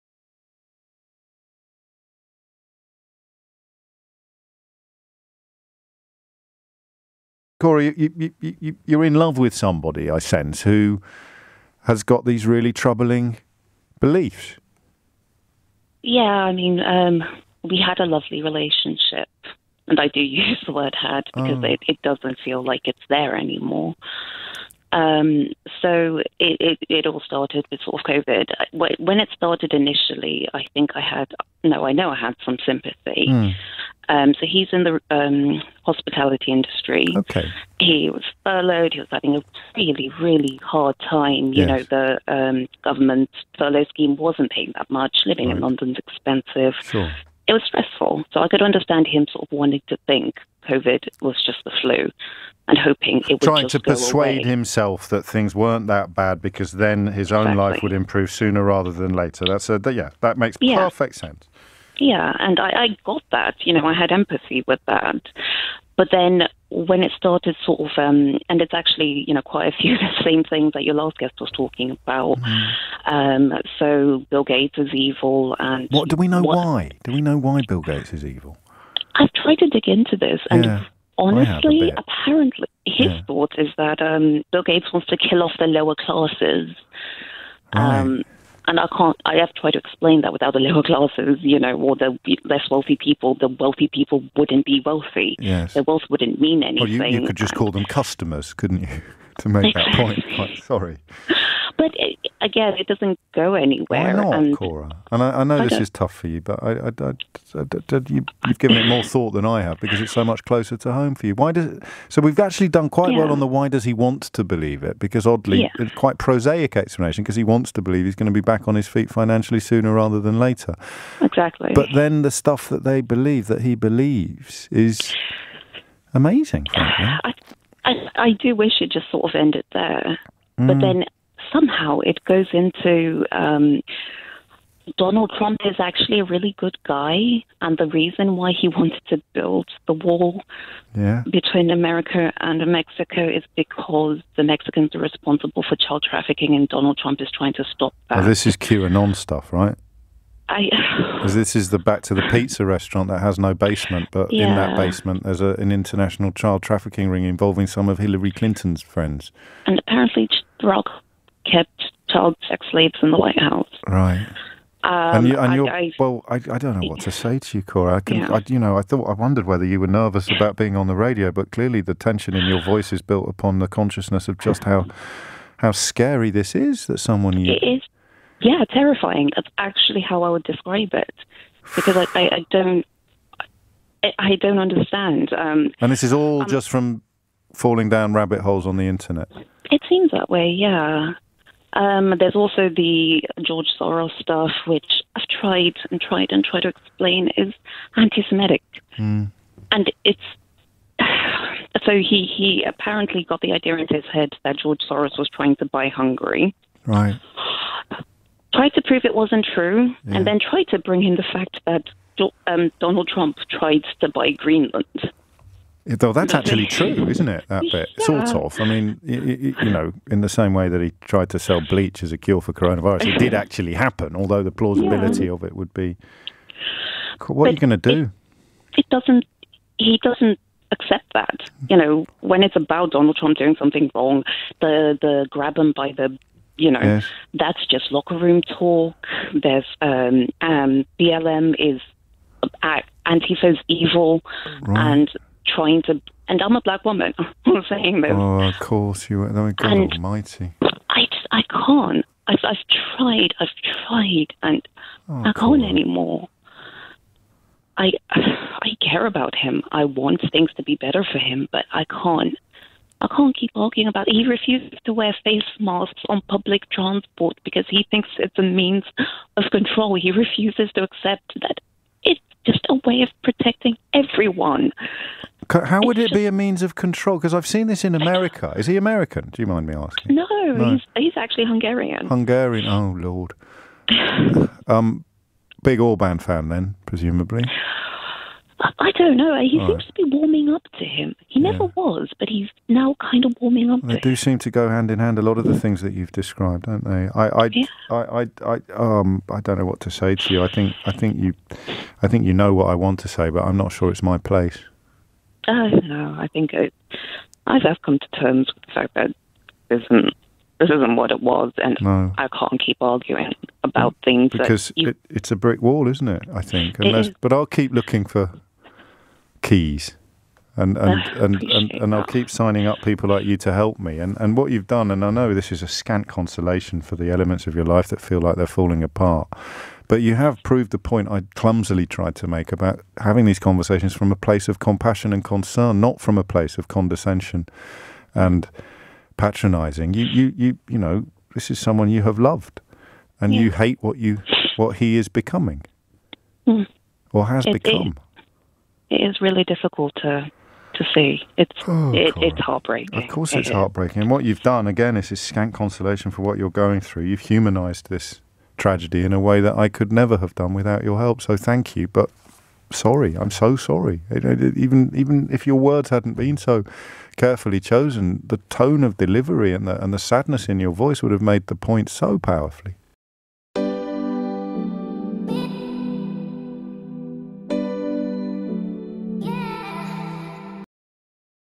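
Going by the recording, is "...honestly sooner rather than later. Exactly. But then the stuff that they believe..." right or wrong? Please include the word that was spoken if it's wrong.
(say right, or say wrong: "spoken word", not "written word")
wrong: "financially", not "honestly".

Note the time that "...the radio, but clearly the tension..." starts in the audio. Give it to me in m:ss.
2:50.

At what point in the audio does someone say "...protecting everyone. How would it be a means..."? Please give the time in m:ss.
4:33.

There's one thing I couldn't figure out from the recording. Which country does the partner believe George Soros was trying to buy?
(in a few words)
Hungary.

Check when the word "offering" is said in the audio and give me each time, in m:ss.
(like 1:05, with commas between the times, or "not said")
not said.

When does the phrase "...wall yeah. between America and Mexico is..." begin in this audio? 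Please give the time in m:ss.
2:19.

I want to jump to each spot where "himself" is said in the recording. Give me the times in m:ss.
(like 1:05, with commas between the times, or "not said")
0:54.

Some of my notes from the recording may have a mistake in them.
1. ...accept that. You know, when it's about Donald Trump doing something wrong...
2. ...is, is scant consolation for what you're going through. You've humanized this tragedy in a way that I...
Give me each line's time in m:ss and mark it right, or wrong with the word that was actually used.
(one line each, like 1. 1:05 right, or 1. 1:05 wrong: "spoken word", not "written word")
1. 3:50 right
2. 5:54 right.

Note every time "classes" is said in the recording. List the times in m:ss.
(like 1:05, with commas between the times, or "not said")
1:25, 1:30.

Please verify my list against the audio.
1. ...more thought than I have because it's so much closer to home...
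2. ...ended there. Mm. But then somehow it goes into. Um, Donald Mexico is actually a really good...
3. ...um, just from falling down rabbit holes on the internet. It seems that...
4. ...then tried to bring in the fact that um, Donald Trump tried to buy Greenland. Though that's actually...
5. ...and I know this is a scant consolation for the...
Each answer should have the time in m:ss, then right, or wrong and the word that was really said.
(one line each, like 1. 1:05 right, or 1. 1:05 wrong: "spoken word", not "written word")
1. 1:48 right
2. 2:09 wrong: "Trump", not "Mexico"
3. 3:06 right
4. 3:30 right
5. 5:24 right.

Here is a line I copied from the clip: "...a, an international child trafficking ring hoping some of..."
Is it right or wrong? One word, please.
wrong.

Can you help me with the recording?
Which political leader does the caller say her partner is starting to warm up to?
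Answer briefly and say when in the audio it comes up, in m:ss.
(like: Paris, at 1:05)
Orban, at 4:45.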